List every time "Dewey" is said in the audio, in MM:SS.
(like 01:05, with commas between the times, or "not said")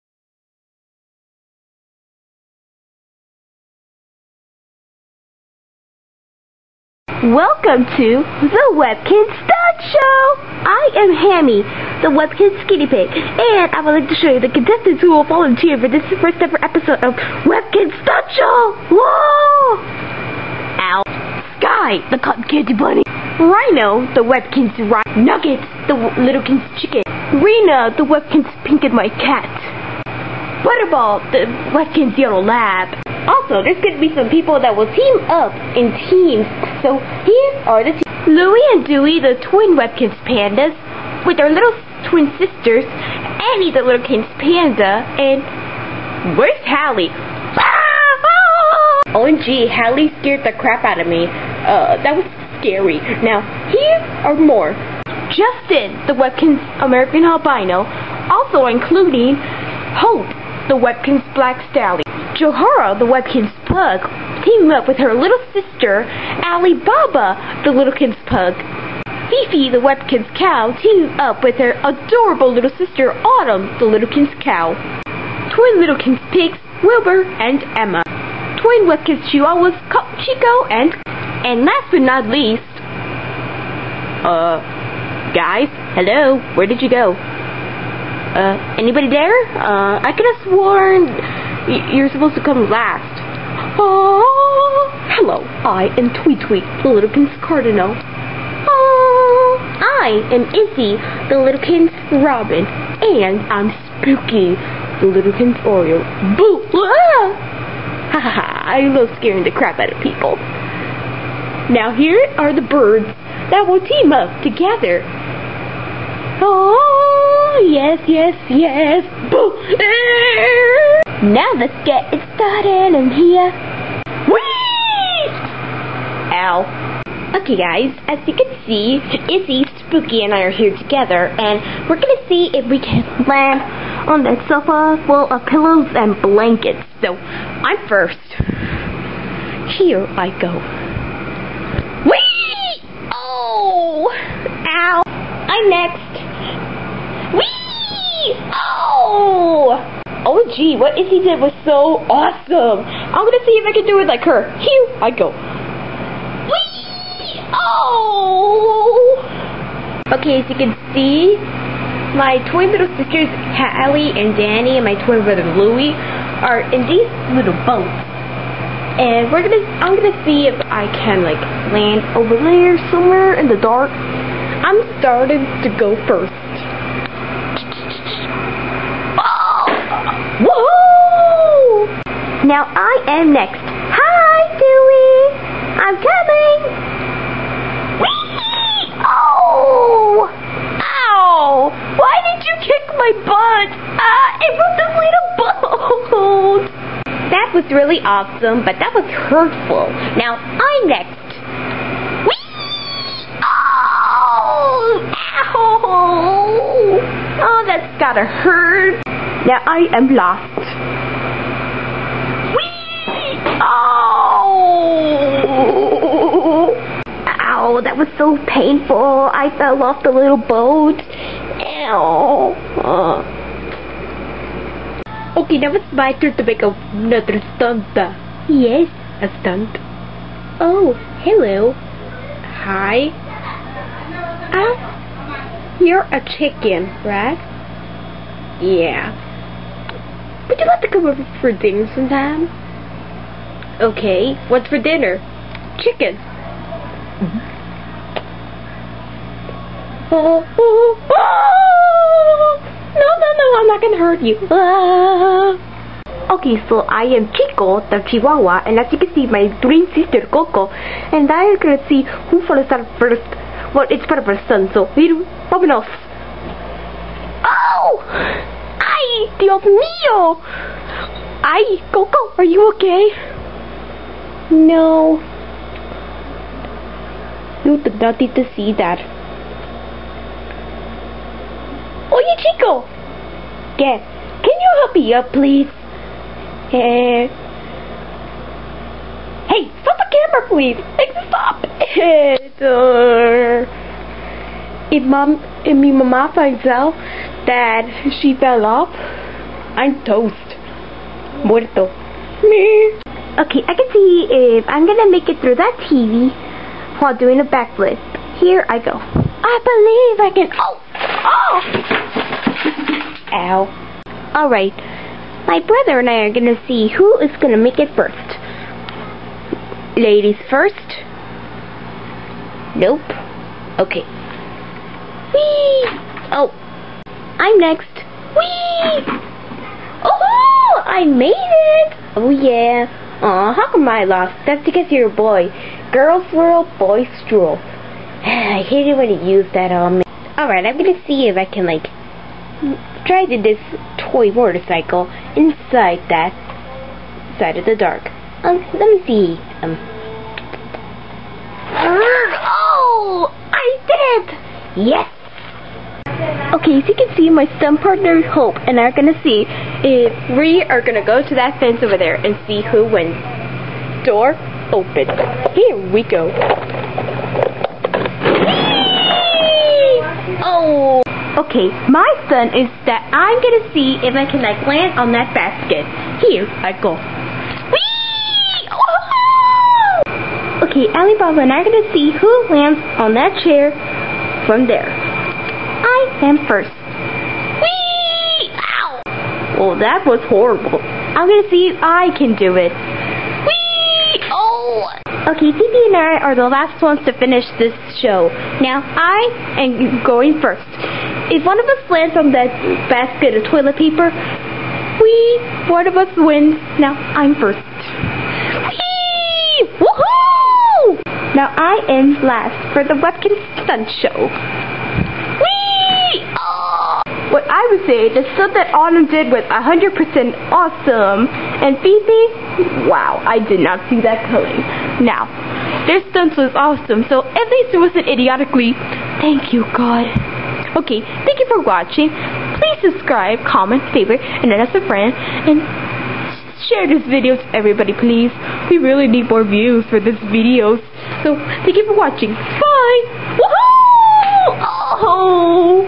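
00:38, 03:04.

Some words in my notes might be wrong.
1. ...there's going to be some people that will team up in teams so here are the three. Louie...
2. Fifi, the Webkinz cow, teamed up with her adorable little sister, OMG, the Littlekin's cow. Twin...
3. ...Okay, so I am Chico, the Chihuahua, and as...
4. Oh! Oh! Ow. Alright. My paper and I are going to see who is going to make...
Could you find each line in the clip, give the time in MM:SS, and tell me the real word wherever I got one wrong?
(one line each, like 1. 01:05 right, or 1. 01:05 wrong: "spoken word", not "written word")
1. 00:33 wrong: "two", not "three"
2. 01:09 wrong: "Autumn", not "OMG"
3. 04:16 right
4. 05:13 wrong: "brother", not "paper".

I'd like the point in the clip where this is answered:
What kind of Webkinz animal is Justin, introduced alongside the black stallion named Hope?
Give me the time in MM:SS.
00:56.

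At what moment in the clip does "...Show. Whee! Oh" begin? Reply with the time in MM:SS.
06:54.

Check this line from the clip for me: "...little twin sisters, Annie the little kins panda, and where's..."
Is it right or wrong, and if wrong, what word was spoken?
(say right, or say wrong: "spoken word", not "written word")
right.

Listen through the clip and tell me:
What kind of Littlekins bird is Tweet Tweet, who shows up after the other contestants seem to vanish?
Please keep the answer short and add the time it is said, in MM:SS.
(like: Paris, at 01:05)
Cardinal, at 01:37.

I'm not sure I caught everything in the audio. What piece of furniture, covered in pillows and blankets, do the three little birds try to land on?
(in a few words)
Sofa.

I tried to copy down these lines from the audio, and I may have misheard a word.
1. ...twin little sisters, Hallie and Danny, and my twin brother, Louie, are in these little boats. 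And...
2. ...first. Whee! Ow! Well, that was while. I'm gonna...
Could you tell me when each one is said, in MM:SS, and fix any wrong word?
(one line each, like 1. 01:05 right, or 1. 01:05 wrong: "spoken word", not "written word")
1. 02:42 right
2. 06:26 wrong: "horrible", not "while".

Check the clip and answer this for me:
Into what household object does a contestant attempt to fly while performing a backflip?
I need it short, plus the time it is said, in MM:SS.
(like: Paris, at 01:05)
TV, at 05:05.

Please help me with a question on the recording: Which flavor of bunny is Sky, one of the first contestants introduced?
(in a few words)
Cotton candy.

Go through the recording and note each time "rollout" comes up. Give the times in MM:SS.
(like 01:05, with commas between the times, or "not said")
not said.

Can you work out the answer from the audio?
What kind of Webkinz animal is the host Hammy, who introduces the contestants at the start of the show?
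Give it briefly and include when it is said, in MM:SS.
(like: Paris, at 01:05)
Skinny Pig, at 00:12.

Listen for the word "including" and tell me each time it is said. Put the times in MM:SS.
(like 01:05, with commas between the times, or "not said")
00:58.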